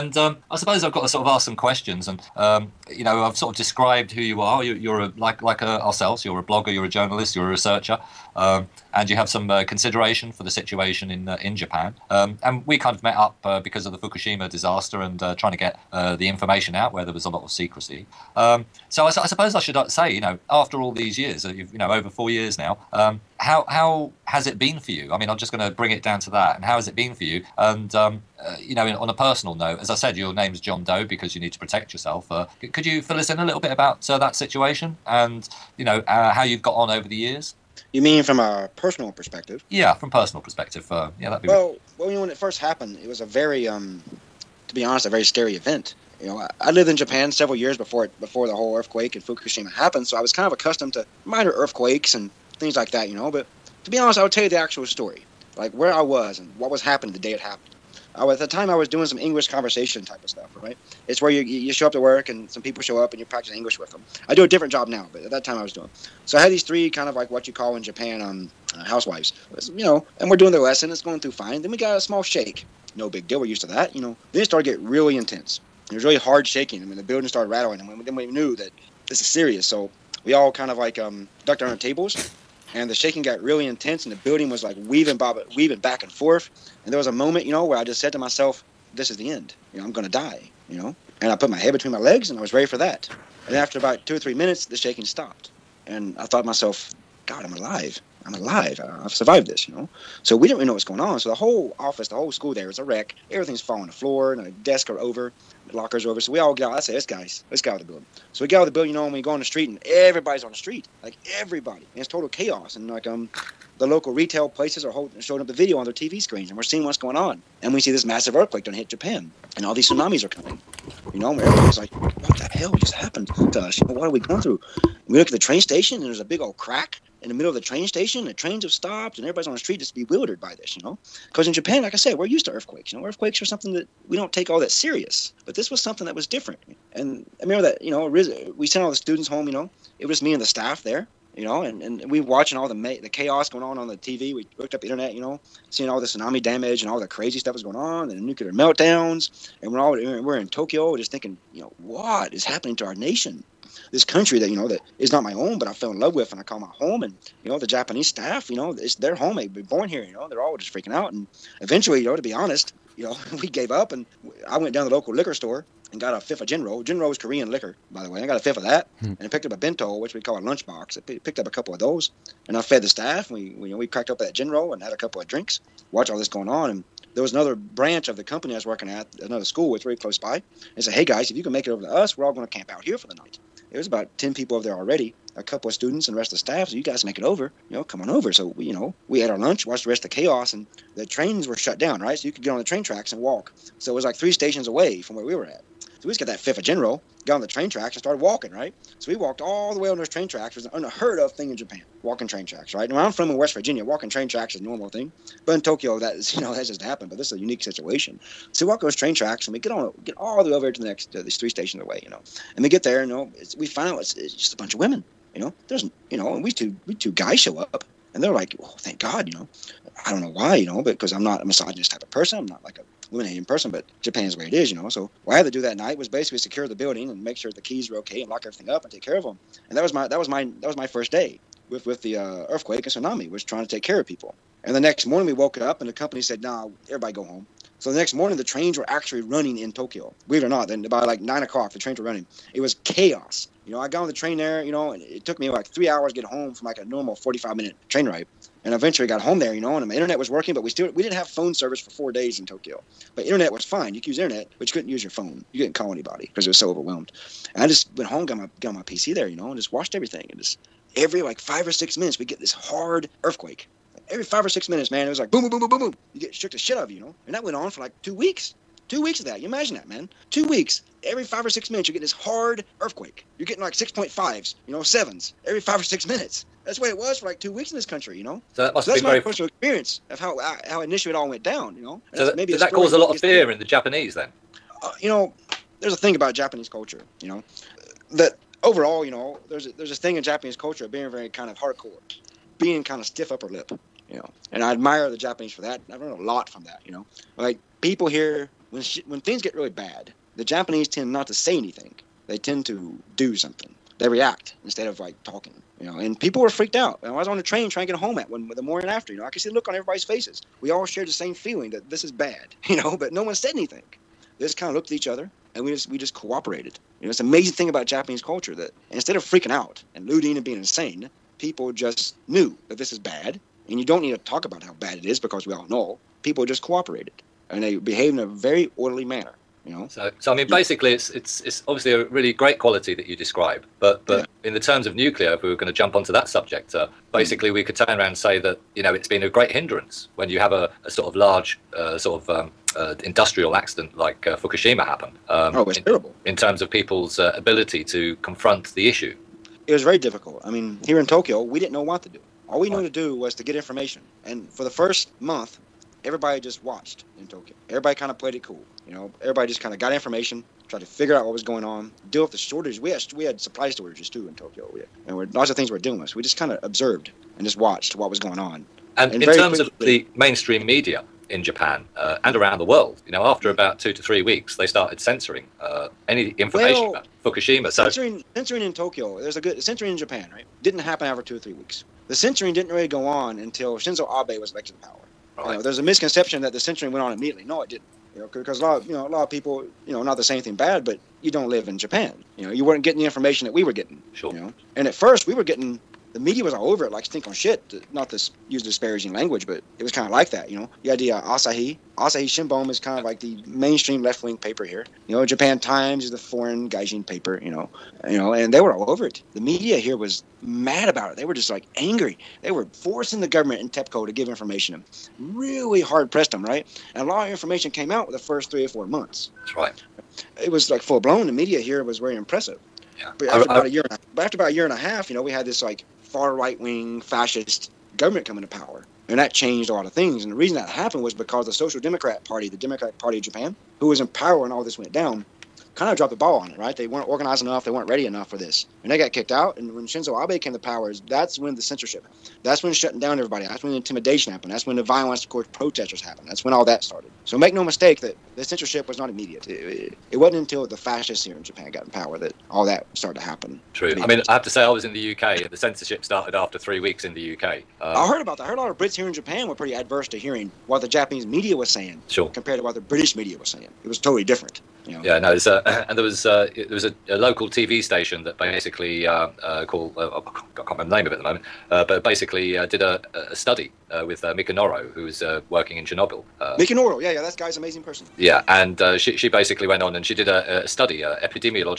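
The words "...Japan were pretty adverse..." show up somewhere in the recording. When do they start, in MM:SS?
07:39.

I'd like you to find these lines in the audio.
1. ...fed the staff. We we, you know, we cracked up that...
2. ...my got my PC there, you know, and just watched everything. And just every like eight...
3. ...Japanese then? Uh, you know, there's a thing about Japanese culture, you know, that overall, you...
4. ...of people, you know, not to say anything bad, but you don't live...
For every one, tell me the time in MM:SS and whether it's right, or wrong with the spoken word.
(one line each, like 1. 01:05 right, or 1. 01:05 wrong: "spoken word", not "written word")
1. 02:52 right
2. 04:18 wrong: "five", not "eight"
3. 04:43 right
4. 06:29 right.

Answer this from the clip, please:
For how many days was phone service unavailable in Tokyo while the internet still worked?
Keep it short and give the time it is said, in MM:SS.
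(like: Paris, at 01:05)
4, at 04:11.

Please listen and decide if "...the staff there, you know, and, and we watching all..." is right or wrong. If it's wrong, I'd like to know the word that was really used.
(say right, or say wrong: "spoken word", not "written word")
right.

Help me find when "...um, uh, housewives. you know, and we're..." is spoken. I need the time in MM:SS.
01:08.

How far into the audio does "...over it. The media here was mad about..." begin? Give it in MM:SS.
06:48.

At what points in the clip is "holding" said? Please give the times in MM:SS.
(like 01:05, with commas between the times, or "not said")
01:54.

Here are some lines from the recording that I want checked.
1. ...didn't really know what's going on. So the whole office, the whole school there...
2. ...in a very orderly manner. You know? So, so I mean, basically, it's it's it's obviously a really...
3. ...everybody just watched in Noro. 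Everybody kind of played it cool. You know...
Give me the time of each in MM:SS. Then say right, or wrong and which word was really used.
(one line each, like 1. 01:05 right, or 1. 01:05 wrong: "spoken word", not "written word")
1. 01:40 right
2. 05:28 right
3. 05:56 wrong: "Tokyo", not "Noro".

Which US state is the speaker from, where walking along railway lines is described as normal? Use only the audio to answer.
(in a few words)
West Virginia.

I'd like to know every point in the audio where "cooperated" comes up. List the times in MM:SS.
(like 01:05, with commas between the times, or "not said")
05:16, 05:26.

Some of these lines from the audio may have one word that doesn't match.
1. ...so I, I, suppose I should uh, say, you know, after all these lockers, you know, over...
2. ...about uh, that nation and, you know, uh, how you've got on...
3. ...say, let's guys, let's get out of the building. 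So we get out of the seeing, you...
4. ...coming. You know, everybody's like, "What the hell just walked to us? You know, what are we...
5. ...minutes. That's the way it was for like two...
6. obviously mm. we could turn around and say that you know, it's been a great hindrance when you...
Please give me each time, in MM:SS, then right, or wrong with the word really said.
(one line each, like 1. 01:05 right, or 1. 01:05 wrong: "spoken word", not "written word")
1. 00:18 wrong: "years", not "lockers"
2. 00:33 wrong: "situation", not "nation"
3. 01:46 wrong: "building", not "seeing"
4. 02:00 wrong: "happened", not "walked"
5. 04:36 right
6. 05:37 wrong: "basically", not "obviously".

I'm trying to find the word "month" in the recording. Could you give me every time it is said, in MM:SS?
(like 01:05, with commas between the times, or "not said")
05:55, 06:58.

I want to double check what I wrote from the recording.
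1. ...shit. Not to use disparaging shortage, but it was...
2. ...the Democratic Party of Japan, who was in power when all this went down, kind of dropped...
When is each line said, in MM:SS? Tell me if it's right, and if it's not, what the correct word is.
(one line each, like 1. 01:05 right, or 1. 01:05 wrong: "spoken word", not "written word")
1. 06:37 wrong: "language", not "shortage"
2. 07:12 right.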